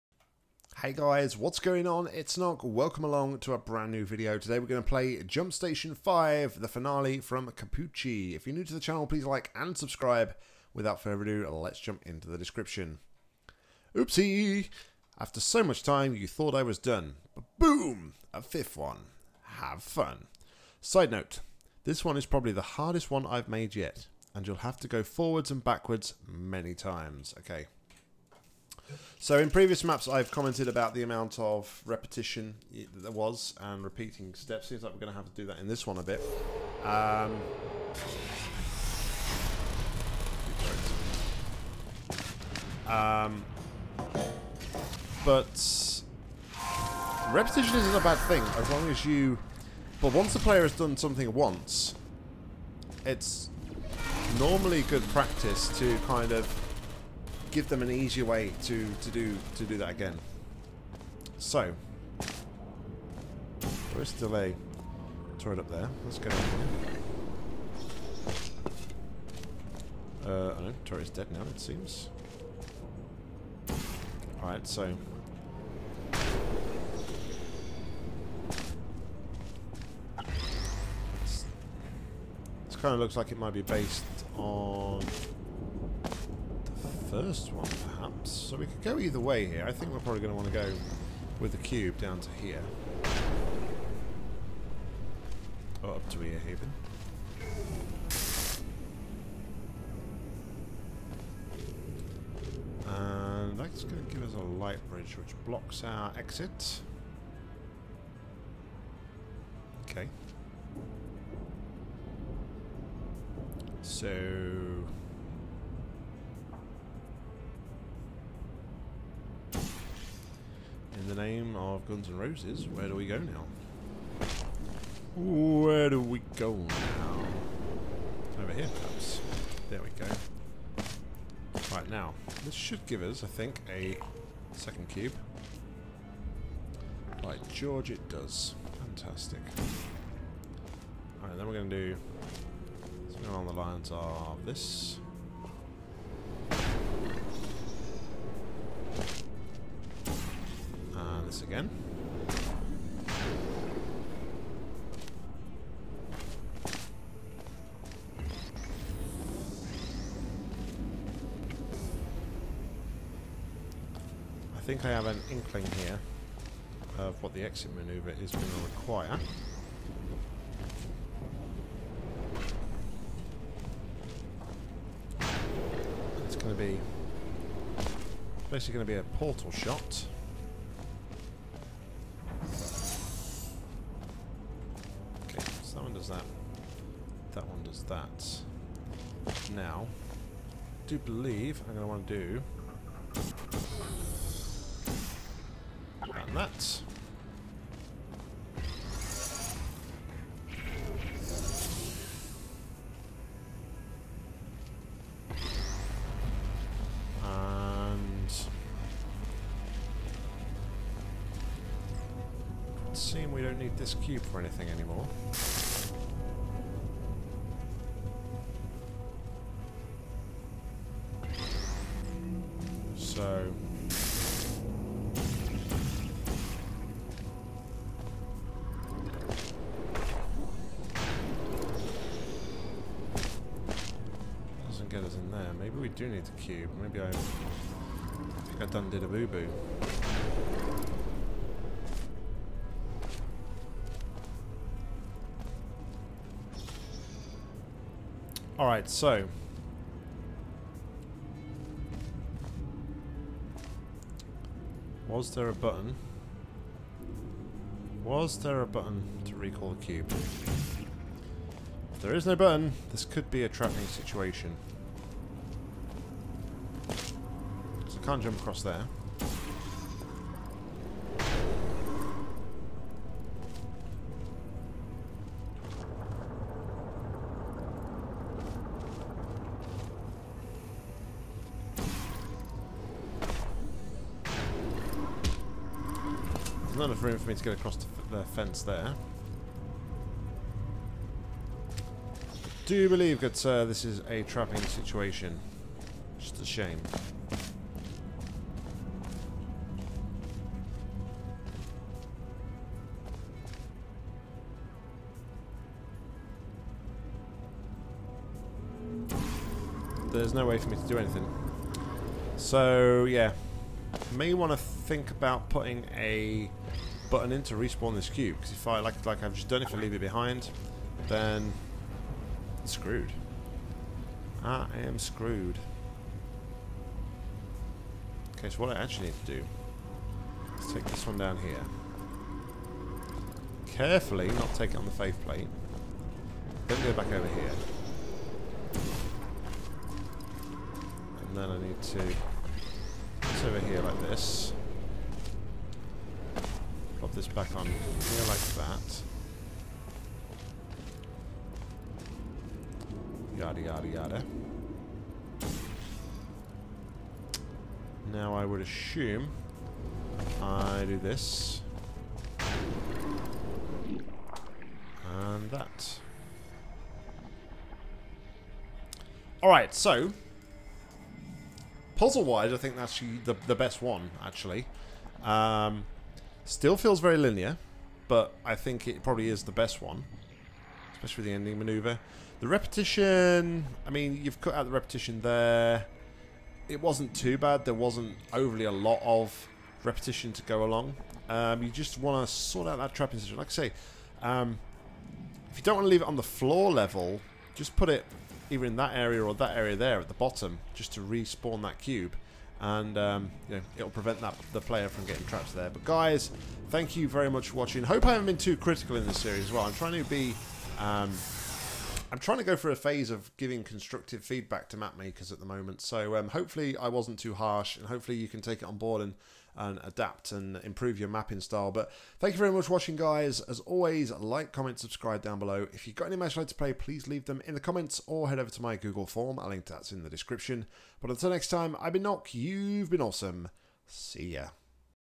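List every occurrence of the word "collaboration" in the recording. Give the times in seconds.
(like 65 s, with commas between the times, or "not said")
not said.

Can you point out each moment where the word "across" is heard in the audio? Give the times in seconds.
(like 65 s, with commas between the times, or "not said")
268 s, 287 s.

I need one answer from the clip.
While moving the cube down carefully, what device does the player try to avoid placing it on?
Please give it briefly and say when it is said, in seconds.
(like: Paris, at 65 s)
the faith plate, at 334 s.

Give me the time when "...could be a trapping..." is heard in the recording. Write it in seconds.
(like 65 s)
263 s.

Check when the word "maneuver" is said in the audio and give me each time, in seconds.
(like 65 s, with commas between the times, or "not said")
167 s, 381 s.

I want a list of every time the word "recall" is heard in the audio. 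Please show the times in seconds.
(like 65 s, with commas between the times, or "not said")
259 s.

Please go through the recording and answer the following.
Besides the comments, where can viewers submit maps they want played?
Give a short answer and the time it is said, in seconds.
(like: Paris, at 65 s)
Google form, at 428 s.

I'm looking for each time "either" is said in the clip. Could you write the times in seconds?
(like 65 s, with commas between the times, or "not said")
88 s, 398 s.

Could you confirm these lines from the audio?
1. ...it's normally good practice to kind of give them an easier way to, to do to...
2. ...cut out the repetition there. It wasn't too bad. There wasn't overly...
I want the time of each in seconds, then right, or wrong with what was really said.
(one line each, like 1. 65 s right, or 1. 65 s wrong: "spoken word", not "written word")
1. 53 s right
2. 384 s right.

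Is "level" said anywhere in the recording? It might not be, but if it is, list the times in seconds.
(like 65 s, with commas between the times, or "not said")
396 s.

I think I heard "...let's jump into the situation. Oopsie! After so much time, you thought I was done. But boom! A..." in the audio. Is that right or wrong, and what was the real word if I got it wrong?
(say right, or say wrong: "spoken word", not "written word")
wrong: "description", not "situation".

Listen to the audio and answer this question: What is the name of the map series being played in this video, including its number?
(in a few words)
Jump Station 5.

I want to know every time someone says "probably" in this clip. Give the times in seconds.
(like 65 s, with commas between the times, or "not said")
22 s, 89 s, 379 s.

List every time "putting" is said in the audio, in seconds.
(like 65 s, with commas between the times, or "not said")
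315 s.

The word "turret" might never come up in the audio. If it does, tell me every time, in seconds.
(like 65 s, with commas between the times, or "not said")
65 s, 70 s.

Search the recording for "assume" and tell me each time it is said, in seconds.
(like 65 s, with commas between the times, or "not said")
358 s.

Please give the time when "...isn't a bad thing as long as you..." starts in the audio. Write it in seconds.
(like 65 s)
47 s.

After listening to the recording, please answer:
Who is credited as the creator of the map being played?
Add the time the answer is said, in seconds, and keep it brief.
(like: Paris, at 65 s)
Cappucci, at 7 s.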